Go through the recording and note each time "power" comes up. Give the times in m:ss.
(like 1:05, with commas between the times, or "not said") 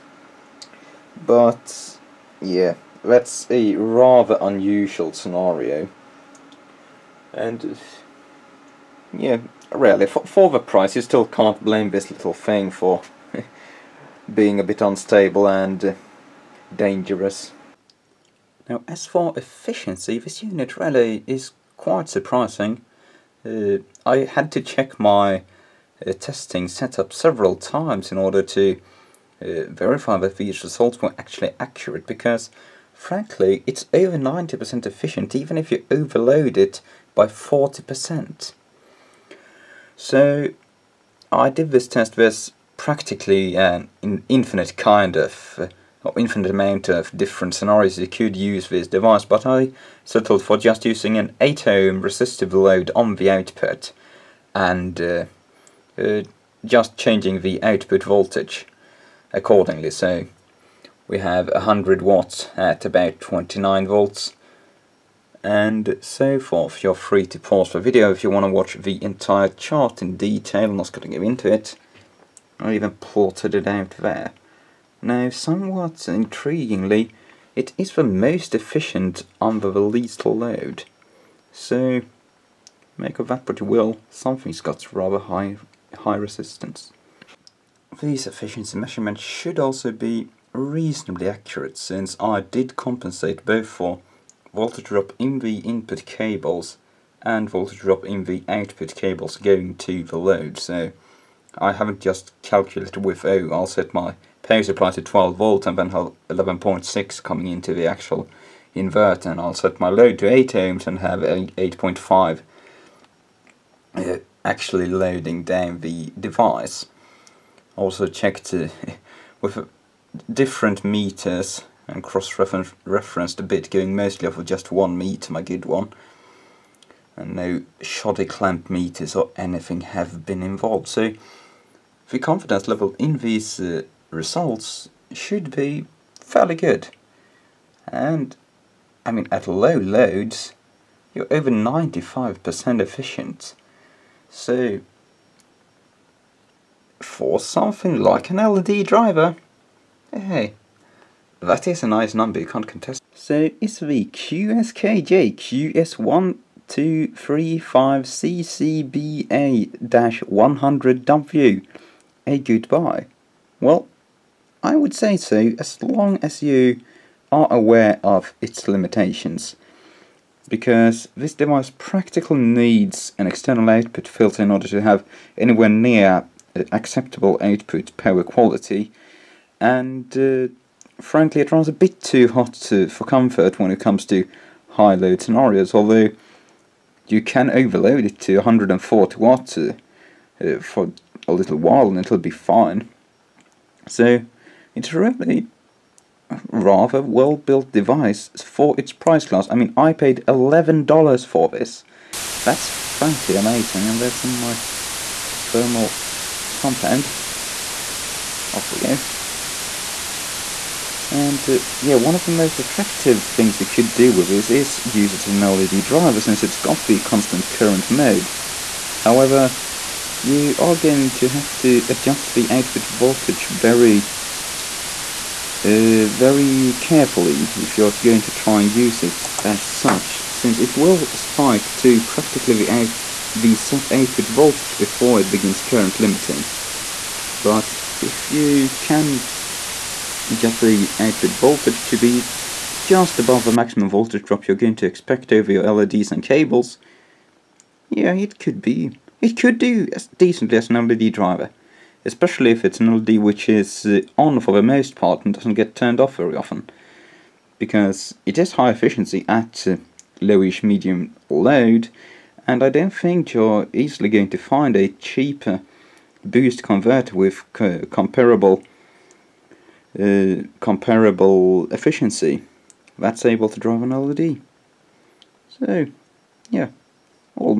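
1:44, 2:57.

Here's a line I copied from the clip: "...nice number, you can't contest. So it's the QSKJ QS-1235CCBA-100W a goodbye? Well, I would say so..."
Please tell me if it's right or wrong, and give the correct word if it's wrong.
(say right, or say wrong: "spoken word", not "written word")
right.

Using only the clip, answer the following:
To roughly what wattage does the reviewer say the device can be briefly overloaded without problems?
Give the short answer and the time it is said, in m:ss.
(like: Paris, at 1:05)
140 watts, at 3:08.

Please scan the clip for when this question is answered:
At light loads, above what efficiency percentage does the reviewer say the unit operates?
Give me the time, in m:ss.
2:21.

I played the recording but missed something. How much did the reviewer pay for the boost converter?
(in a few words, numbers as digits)
$11.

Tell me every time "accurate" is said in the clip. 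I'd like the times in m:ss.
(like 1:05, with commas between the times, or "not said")
0:31, 1:31.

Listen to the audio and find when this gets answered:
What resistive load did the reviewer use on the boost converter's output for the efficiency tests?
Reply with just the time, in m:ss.
0:51.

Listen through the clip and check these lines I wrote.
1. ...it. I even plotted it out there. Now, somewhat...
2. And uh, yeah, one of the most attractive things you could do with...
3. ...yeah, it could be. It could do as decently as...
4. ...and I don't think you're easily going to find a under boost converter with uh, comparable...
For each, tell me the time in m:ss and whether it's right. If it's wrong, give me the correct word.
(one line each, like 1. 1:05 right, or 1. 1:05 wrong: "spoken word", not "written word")
1. 1:11 right
2. 3:31 right
3. 4:07 right
4. 4:22 wrong: "cheaper", not "under".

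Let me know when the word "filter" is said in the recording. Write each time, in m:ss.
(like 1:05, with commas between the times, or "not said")
2:54.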